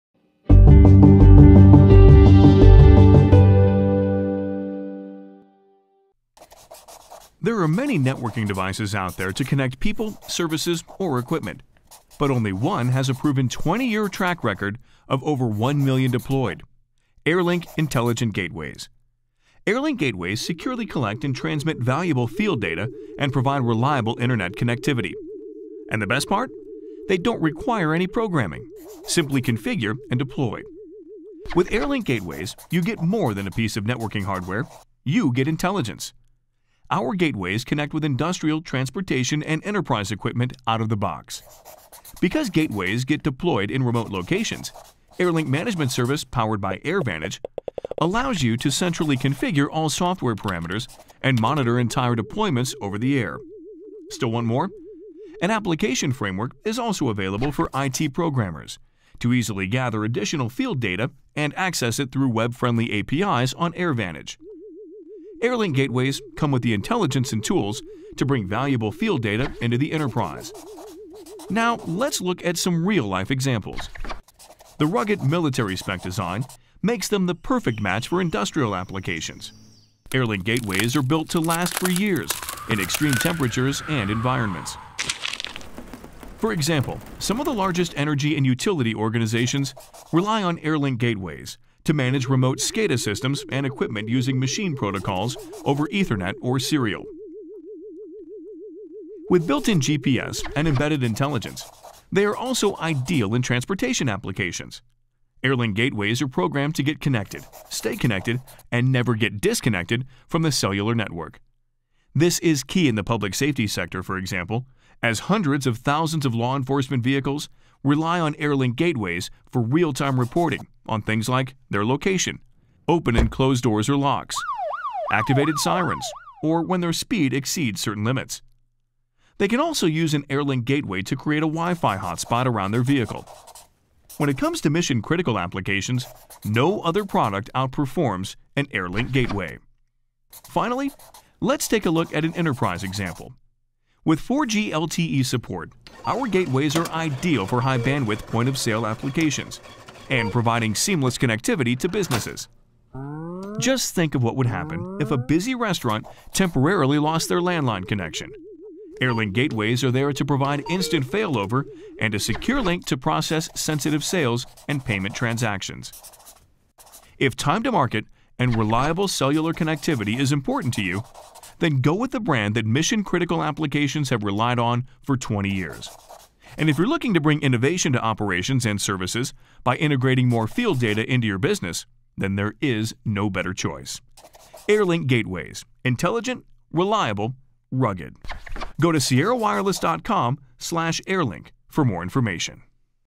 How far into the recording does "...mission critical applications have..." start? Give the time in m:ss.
2:52.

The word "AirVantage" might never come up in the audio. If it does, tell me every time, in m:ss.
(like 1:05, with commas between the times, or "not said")
0:46, 1:03.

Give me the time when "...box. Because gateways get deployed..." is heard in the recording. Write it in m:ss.
0:40.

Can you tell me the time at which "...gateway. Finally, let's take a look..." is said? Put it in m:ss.
2:19.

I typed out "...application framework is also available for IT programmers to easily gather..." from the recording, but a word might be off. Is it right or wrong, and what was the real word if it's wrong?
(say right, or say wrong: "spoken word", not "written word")
right.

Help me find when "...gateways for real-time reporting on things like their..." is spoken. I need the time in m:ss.
1:58.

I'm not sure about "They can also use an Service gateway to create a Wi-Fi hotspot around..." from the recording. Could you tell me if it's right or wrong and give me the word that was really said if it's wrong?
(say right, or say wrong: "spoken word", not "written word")
wrong: "Airlink", not "Service".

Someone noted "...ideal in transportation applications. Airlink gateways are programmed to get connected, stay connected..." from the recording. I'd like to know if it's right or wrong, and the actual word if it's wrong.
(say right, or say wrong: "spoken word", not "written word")
right.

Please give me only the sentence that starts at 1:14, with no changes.
The rugged military spec design makes them the perfect match for industrial applications.